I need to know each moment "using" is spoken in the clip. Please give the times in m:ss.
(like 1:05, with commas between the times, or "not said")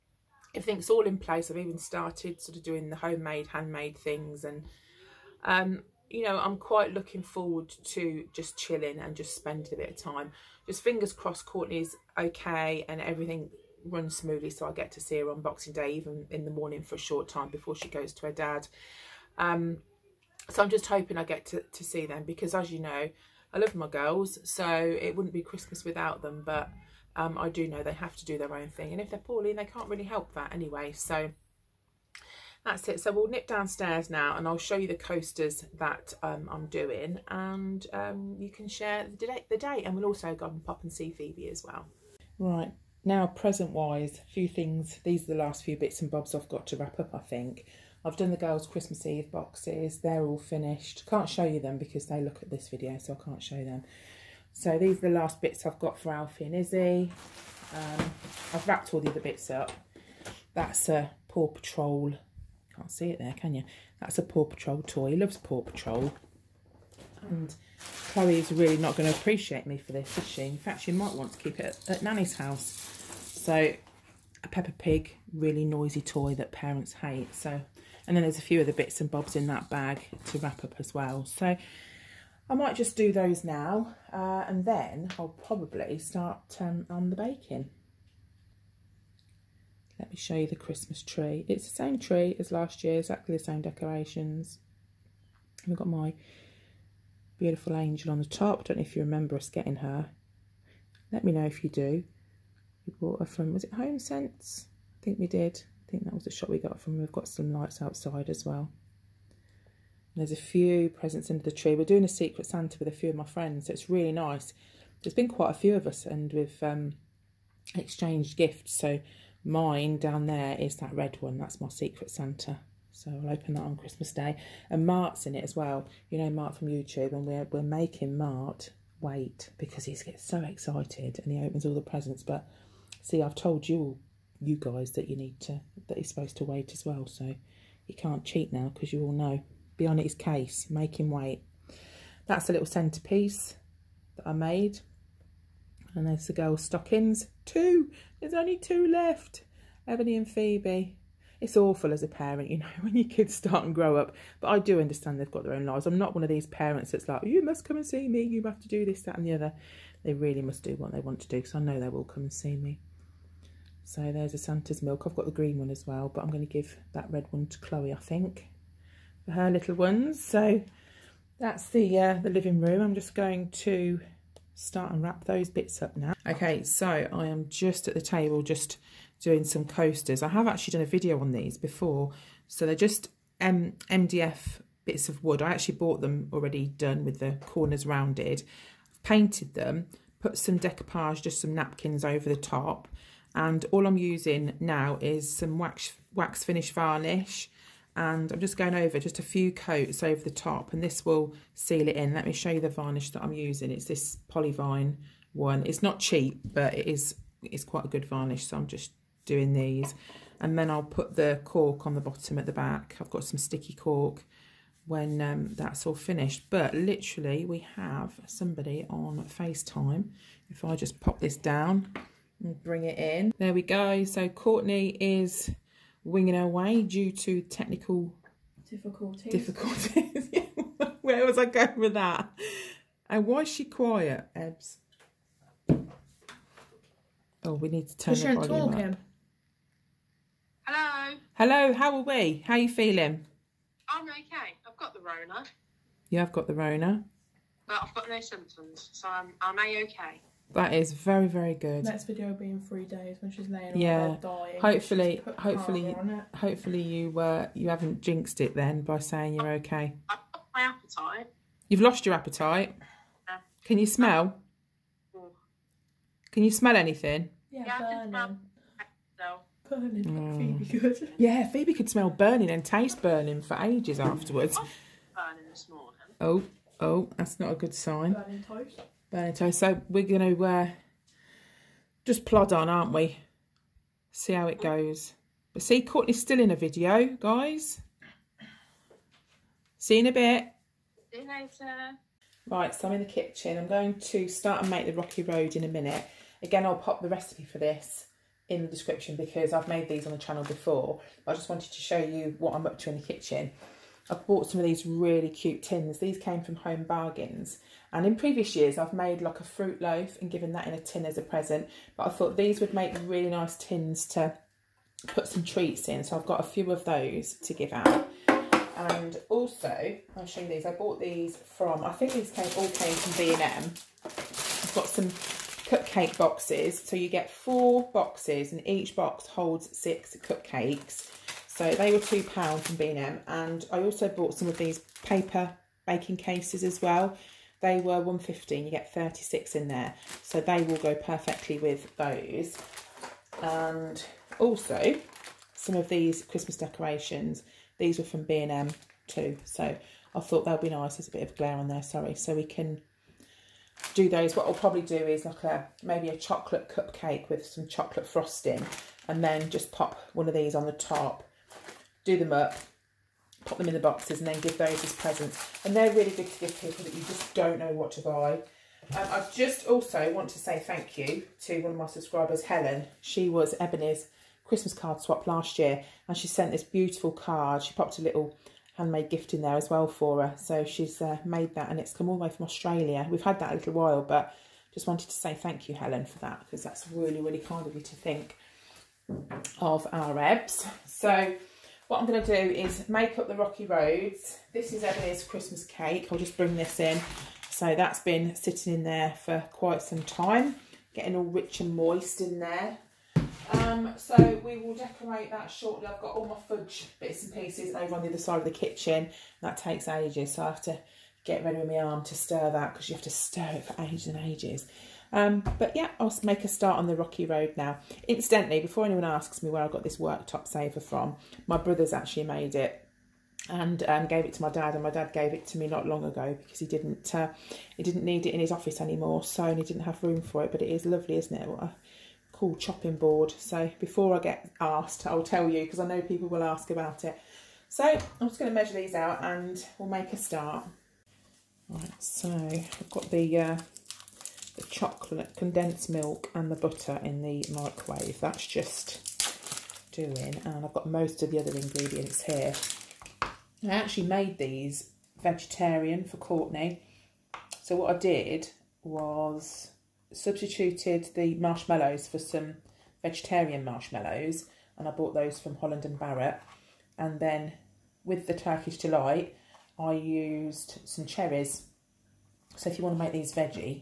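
3:13, 3:23.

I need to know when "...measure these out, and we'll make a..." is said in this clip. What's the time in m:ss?
7:18.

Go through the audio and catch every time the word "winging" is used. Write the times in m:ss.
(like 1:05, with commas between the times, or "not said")
3:46.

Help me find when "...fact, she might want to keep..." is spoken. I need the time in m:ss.
1:10.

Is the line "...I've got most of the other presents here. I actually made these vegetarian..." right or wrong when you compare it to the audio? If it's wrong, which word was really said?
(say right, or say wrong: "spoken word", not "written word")
wrong: "ingredients", not "presents".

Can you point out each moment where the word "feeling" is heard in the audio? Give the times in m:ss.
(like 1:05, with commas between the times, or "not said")
4:02.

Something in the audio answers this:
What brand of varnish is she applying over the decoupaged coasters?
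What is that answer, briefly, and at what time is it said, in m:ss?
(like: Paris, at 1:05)
Polyvine, at 3:24.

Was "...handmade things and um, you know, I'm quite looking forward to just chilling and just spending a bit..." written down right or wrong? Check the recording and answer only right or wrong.
right.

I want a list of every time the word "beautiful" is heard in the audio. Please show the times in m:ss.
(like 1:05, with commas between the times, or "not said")
1:37, 6:16.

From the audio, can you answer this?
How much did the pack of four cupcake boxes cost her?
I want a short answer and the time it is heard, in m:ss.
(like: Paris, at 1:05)
£2, at 5:31.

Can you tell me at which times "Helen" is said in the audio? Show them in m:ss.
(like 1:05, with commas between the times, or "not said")
6:12, 6:25.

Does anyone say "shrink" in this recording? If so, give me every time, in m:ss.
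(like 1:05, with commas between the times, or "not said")
not said.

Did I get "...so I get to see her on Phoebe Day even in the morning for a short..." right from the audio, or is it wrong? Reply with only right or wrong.
wrong.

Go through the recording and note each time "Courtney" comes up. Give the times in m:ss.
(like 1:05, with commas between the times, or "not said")
0:11, 3:44, 4:45, 7:36.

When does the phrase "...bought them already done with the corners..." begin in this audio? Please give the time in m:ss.
3:05.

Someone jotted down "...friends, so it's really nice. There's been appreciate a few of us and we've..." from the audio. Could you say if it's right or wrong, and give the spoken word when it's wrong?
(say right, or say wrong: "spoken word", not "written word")
wrong: "quite", not "appreciate".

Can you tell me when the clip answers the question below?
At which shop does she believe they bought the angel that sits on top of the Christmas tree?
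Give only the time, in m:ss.
1:43.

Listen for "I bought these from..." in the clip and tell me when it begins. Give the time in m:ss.
5:20.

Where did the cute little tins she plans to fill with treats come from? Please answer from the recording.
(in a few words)
Home Bargains.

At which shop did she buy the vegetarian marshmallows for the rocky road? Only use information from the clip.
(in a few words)
Holland and Barrett.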